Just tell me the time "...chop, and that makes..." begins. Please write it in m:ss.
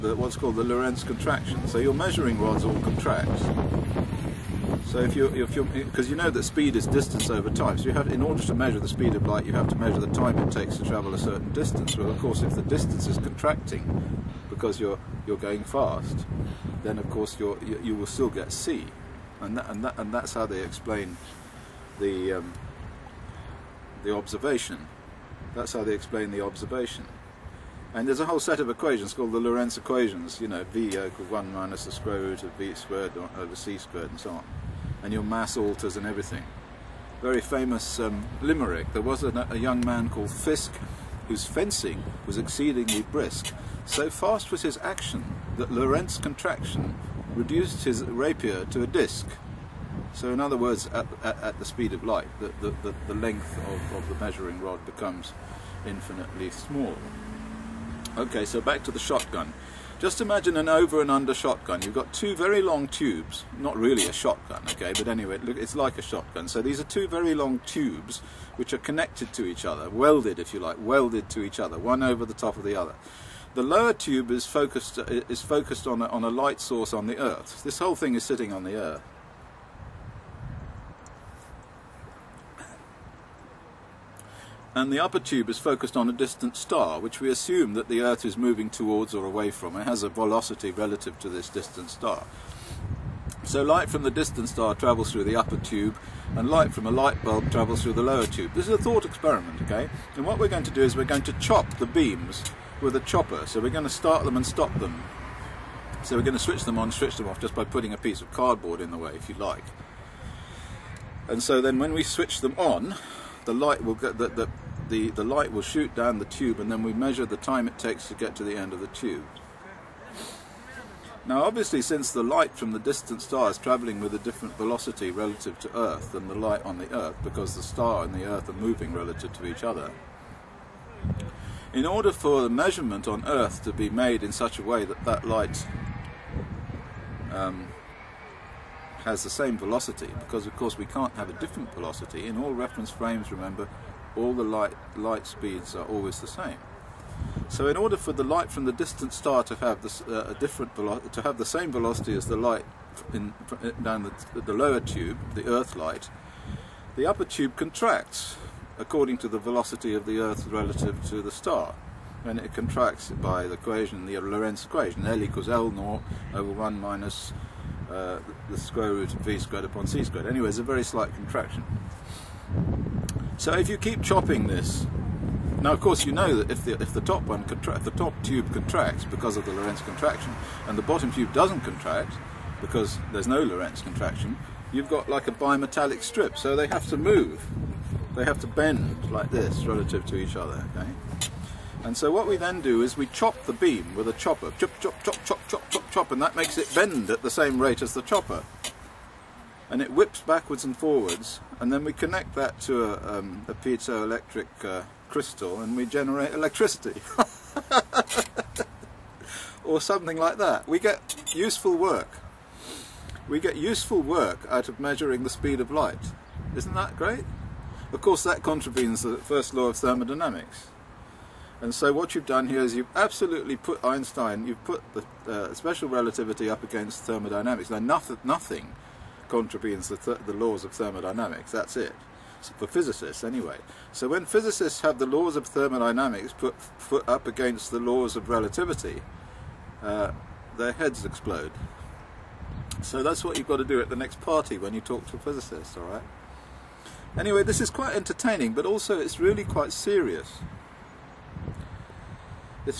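3:15.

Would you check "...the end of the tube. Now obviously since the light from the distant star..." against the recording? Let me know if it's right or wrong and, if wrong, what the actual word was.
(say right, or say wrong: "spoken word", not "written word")
right.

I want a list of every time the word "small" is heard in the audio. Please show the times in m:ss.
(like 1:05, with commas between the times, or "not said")
0:56.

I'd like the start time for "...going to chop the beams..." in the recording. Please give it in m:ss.
1:41.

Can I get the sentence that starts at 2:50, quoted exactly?
Anyway, it's a very slight contraction.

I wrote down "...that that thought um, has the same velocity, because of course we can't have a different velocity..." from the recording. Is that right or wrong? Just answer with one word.
wrong.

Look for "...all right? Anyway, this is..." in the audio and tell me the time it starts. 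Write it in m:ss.
4:05.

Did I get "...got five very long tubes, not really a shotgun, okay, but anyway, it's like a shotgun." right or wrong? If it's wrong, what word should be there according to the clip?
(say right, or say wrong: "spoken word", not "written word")
wrong: "two", not "five".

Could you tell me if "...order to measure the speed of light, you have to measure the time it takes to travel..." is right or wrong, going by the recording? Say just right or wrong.
right.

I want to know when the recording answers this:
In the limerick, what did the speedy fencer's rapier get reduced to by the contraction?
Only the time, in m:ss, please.
0:48.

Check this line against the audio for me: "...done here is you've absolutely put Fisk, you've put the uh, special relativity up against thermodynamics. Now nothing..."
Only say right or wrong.
wrong.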